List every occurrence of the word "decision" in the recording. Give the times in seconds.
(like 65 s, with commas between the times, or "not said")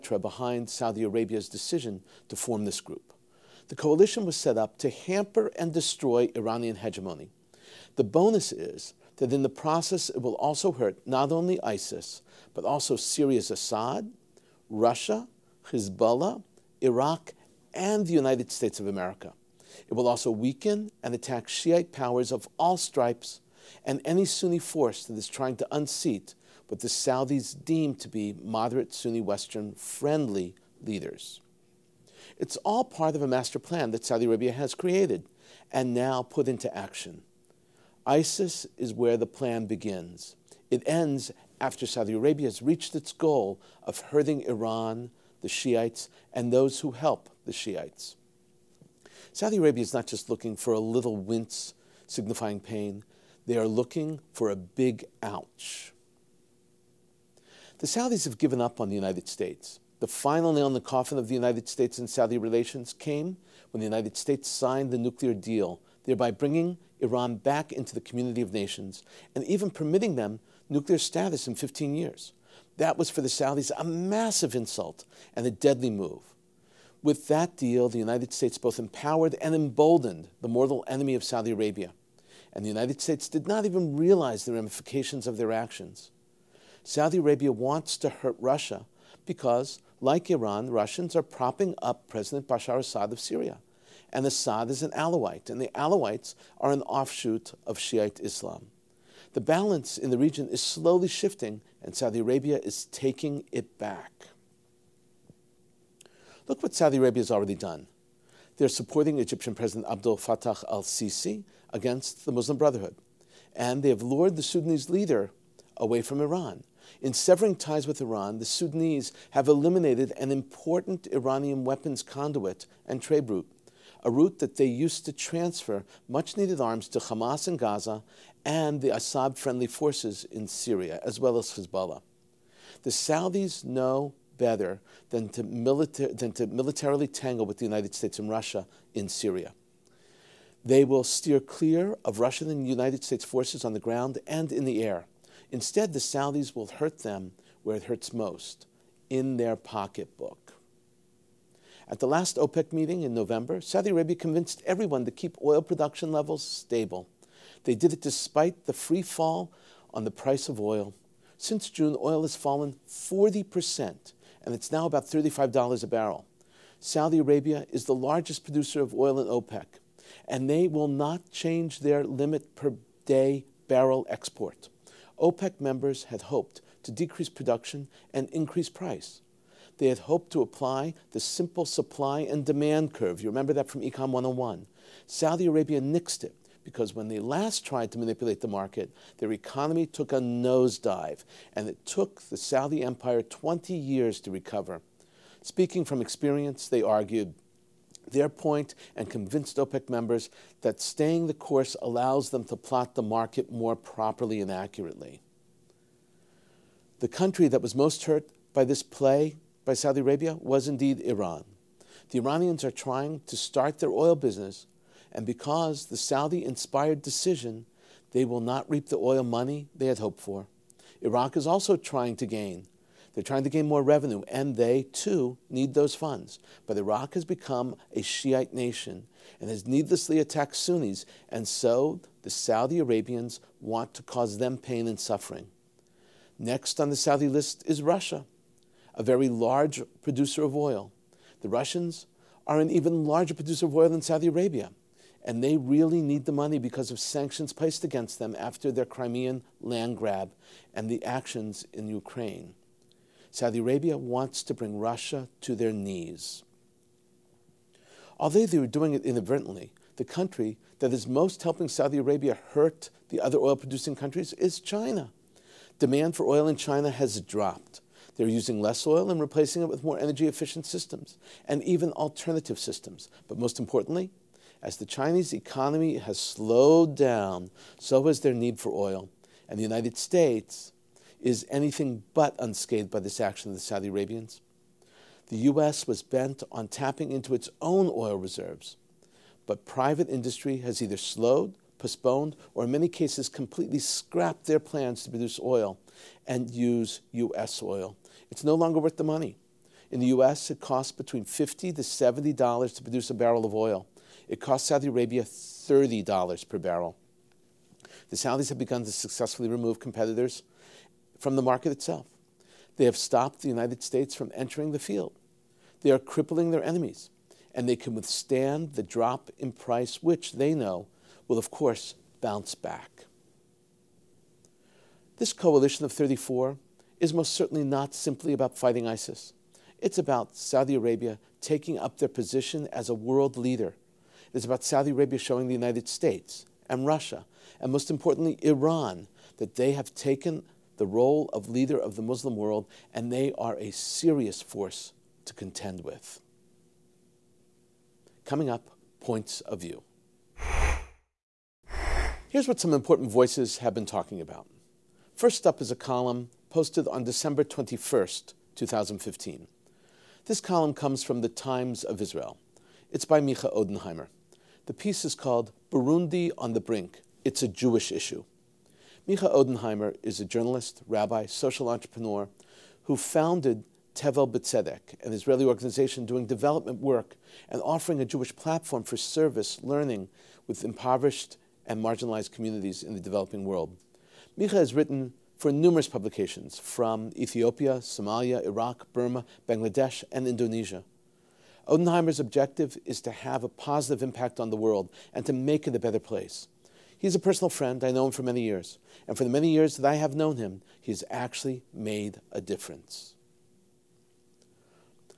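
1 s, 217 s.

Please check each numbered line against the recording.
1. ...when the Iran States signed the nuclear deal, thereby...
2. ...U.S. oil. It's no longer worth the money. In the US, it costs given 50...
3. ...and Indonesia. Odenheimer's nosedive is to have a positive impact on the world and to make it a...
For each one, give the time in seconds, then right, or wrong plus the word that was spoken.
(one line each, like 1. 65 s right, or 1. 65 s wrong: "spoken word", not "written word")
1. 63 s wrong: "United", not "Iran"
2. 297 s wrong: "between", not "given"
3. 390 s wrong: "objective", not "nosedive".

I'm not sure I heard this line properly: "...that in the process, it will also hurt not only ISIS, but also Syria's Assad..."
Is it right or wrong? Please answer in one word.
right.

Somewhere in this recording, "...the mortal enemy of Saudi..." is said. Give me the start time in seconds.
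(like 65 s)
80 s.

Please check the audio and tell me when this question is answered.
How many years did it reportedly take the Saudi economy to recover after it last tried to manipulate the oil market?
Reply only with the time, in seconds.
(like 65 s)
193 s.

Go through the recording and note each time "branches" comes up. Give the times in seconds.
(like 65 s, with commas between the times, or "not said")
not said.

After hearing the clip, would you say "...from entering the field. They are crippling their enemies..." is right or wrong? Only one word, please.
right.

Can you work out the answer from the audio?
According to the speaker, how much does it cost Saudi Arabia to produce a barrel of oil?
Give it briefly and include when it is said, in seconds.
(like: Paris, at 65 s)
$30, at 305 s.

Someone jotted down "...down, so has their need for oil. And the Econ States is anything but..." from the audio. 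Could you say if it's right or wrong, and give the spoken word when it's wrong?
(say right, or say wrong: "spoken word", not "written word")
wrong: "United", not "Econ".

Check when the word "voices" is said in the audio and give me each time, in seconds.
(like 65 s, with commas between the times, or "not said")
353 s.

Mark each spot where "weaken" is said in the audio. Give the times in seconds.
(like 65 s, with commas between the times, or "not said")
20 s.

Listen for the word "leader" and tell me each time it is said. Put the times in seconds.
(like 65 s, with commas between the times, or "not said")
30 s, 114 s, 333 s, 341 s.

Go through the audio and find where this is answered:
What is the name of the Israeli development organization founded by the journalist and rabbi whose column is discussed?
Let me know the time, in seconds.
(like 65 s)
373 s.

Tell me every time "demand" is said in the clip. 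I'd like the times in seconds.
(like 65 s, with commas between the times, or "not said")
182 s, 265 s.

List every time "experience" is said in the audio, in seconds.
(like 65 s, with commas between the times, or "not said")
196 s.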